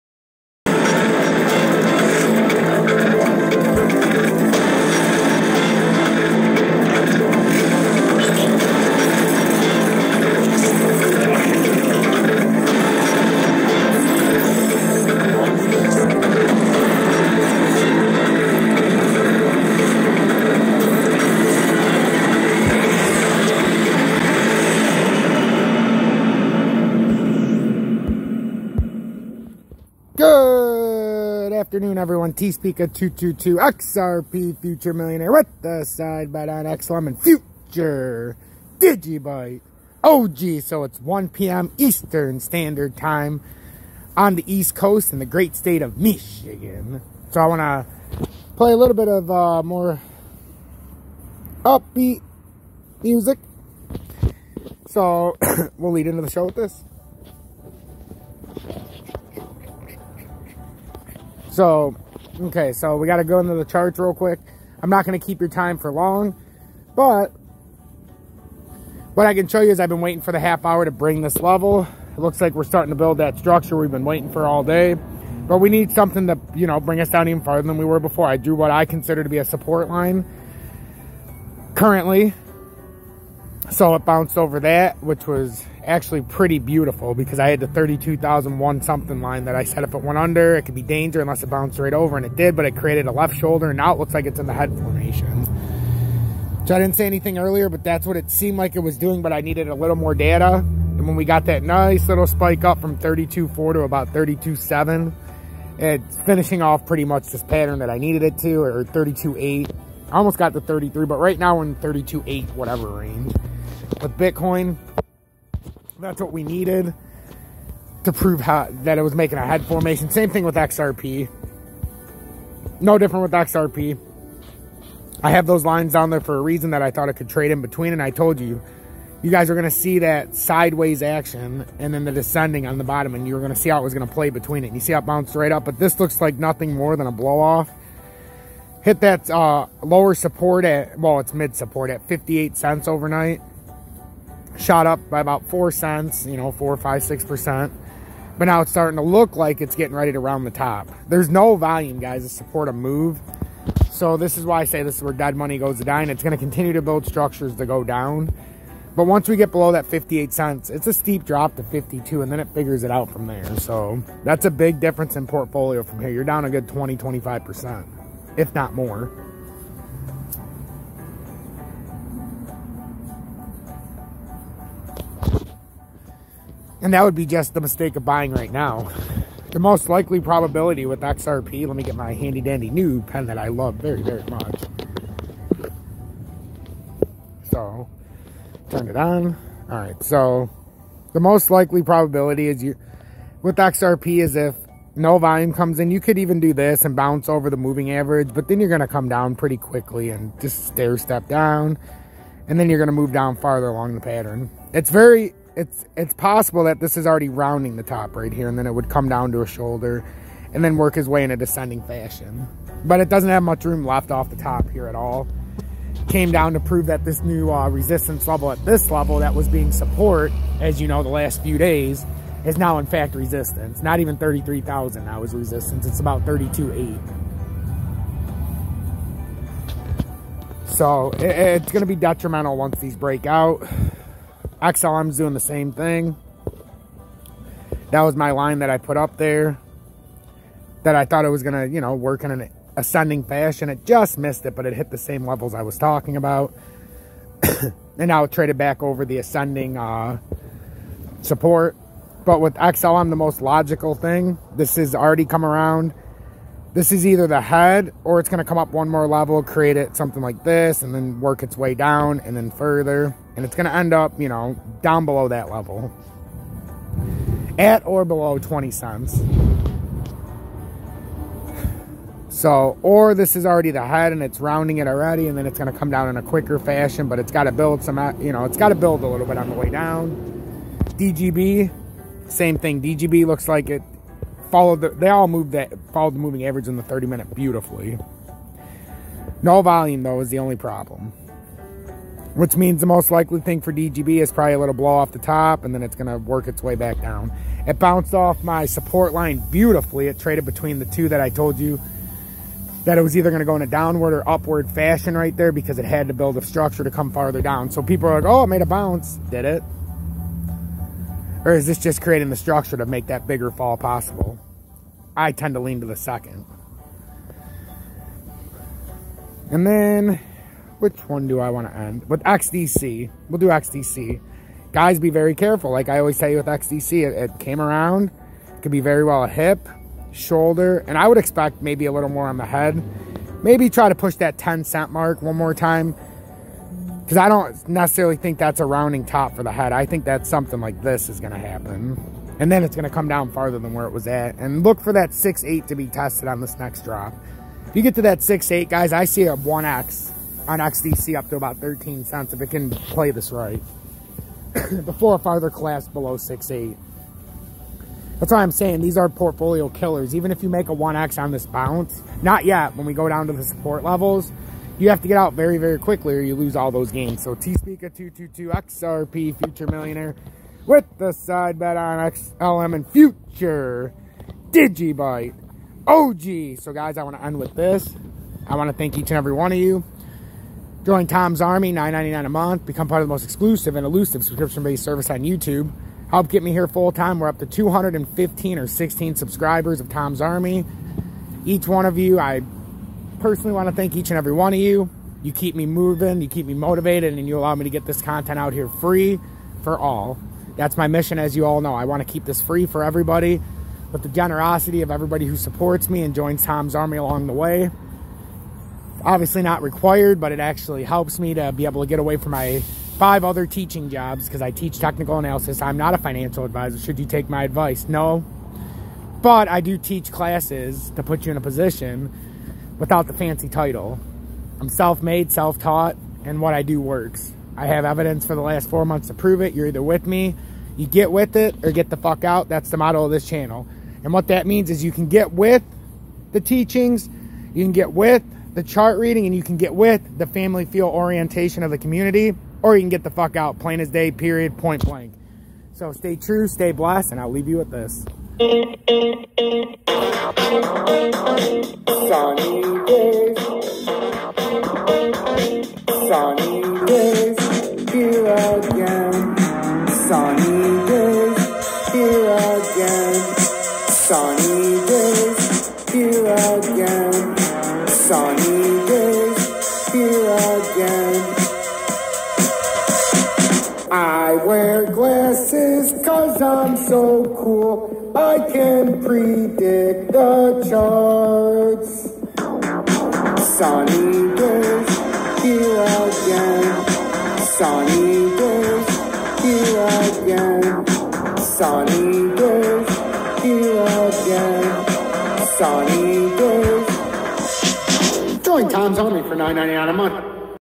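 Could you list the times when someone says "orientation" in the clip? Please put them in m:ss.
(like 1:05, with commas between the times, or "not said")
7:20.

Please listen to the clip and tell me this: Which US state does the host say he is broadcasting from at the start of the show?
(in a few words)
Michigan.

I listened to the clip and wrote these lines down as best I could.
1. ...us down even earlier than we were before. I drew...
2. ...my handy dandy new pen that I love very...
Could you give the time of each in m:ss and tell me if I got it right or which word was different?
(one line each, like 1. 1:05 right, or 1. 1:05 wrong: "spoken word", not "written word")
1. 1:17 wrong: "farther", not "earlier"
2. 3:01 right.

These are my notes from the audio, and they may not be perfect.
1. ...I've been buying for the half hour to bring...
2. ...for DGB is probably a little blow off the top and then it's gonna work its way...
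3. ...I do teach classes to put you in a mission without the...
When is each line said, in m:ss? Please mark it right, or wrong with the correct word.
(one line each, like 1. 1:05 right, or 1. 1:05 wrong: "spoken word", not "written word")
1. 1:09 wrong: "waiting", not "buying"
2. 4:53 right
3. 6:59 wrong: "position", not "mission".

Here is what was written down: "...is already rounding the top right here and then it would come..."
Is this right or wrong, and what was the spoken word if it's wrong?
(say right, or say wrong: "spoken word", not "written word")
right.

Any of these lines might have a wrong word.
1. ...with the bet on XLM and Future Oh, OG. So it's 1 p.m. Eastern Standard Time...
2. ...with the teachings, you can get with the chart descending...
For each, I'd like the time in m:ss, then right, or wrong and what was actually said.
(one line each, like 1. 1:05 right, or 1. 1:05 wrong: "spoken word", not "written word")
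1. 0:35 right
2. 7:15 wrong: "reading", not "descending".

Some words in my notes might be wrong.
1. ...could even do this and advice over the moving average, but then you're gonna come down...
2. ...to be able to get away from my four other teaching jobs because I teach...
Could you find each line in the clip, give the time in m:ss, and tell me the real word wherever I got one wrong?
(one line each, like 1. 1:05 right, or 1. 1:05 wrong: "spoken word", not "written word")
1. 3:15 wrong: "bounce", not "advice"
2. 6:51 wrong: "five", not "four".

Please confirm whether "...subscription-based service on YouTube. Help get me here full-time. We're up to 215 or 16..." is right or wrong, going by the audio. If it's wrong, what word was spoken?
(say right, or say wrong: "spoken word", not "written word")
right.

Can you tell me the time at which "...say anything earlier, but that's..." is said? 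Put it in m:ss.
1:36.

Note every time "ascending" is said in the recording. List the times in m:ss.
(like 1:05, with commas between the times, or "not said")
4:02, 4:09.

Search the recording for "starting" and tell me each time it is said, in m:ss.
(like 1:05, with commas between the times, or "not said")
1:12, 2:28.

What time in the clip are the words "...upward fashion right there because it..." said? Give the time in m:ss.
5:04.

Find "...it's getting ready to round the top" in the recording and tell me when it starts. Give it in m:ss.
2:29.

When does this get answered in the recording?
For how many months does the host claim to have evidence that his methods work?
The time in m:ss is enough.
7:08.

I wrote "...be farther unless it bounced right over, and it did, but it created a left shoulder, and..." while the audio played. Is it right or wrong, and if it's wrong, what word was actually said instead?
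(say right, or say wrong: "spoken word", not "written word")
wrong: "danger", not "farther".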